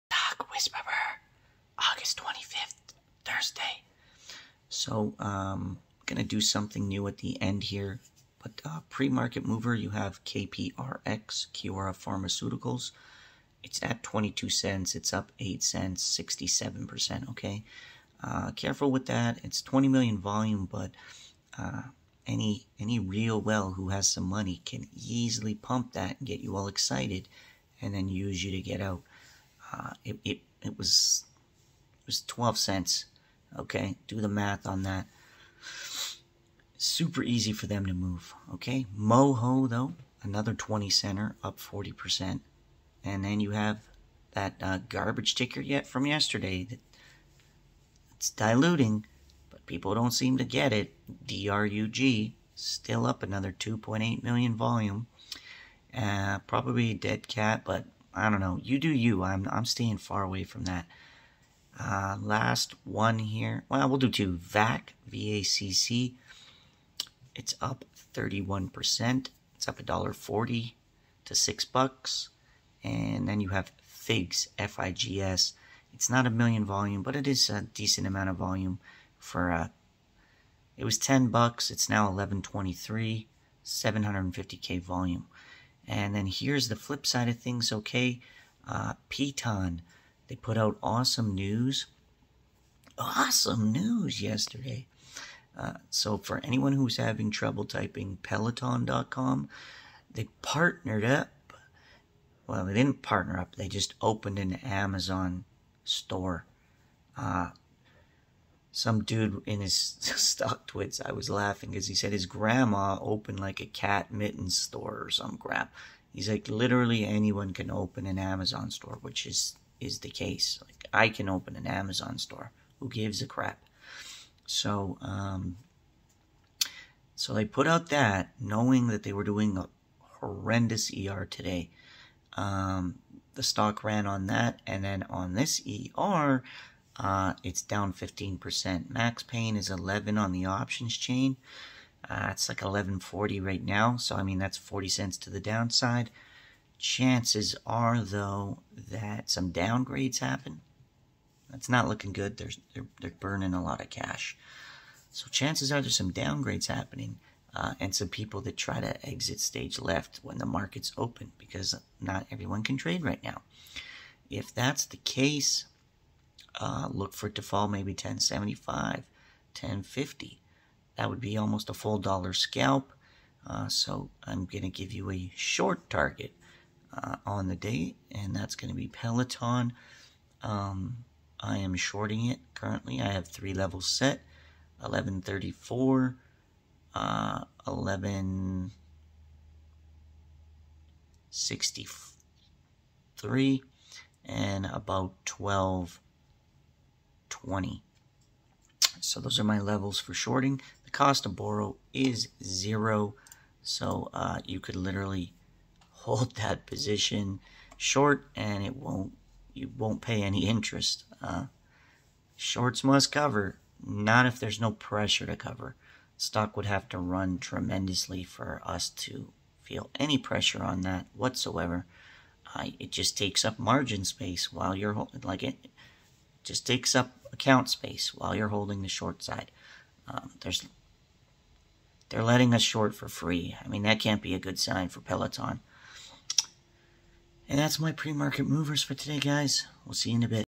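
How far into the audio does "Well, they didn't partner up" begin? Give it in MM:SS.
01:42.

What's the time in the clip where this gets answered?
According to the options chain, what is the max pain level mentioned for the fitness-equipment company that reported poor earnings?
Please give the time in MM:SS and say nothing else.
02:19.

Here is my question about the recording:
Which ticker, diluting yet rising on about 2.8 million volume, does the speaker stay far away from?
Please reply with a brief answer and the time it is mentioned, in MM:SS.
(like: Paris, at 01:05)
DRUG, at 00:51.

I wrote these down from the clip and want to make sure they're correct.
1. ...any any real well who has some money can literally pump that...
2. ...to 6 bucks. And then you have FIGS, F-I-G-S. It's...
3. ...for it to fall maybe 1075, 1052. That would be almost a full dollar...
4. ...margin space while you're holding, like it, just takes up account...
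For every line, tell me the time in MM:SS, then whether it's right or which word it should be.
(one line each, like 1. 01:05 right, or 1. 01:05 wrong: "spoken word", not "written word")
1. 00:22 wrong: "easily", not "literally"
2. 01:11 right
3. 02:47 wrong: "1050", not "1052"
4. 03:43 right.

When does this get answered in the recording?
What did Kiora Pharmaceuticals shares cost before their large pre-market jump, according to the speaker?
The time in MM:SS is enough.
00:32.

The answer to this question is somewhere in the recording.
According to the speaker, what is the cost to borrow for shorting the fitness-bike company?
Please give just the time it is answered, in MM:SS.
03:22.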